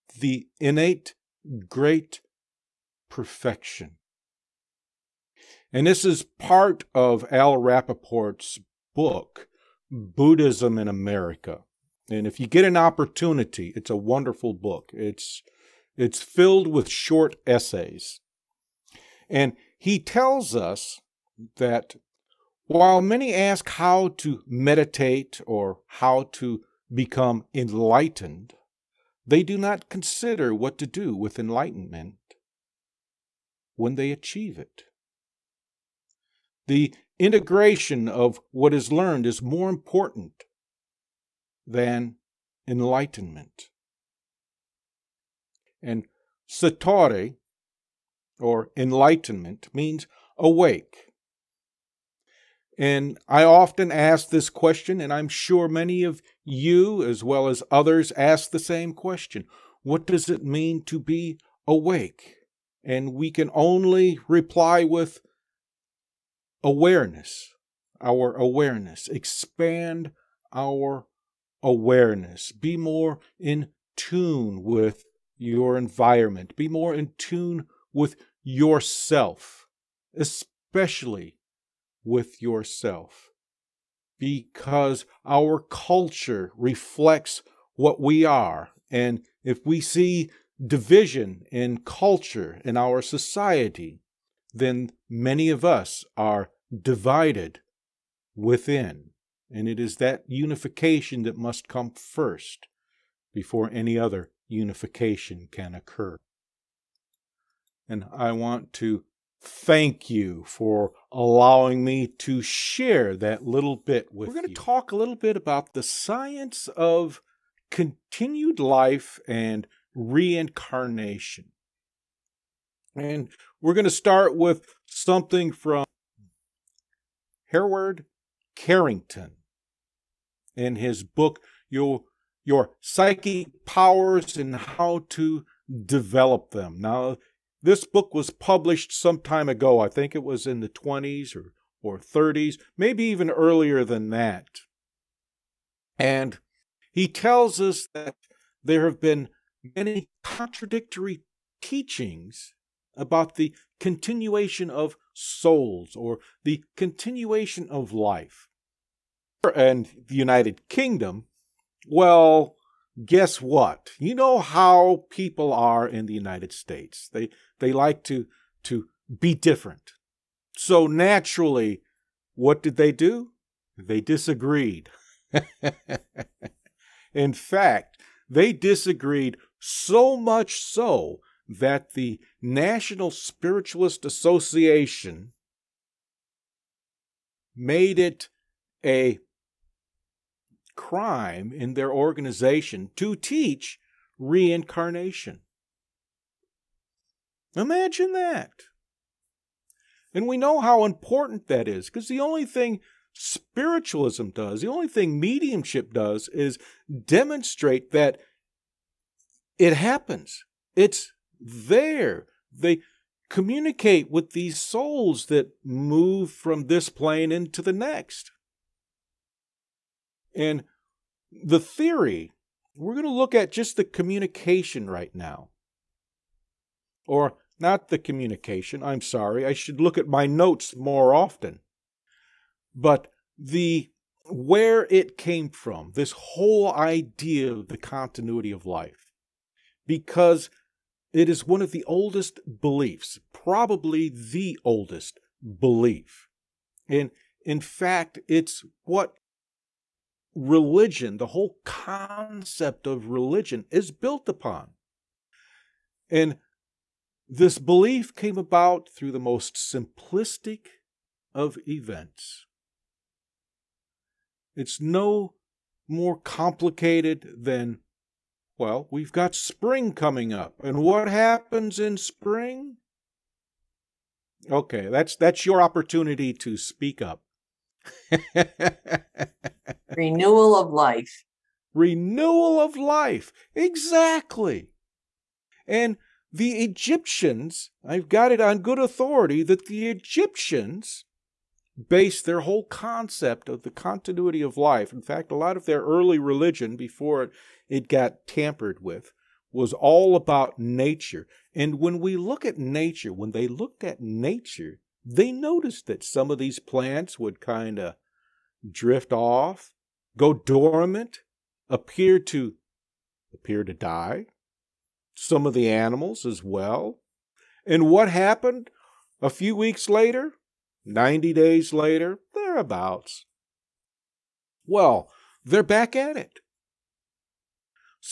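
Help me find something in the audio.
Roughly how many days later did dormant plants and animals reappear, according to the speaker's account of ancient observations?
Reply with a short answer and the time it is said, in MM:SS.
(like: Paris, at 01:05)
90, at 05:20.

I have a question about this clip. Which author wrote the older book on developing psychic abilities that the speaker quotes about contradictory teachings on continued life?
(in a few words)
Hereward Carrington.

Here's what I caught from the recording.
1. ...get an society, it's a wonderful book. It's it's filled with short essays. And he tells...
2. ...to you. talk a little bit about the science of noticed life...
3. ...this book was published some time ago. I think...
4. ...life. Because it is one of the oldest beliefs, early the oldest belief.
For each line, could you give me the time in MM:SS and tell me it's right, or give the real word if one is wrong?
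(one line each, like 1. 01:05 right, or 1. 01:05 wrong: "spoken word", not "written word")
1. 00:12 wrong: "opportunity", not "society"
2. 01:54 wrong: "continued", not "noticed"
3. 02:17 right
4. 03:58 wrong: "probably", not "early".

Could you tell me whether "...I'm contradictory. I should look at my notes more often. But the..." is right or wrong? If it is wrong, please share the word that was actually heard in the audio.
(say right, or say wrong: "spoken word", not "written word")
wrong: "sorry", not "contradictory".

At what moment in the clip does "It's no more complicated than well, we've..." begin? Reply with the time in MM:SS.
04:24.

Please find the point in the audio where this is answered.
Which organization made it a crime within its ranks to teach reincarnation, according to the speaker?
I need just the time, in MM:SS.
03:02.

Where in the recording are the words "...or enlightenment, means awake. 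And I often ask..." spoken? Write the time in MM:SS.
00:48.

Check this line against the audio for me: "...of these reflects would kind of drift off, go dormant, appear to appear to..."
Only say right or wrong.
wrong.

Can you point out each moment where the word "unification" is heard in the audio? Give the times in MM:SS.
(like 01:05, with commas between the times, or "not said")
01:40, 01:44.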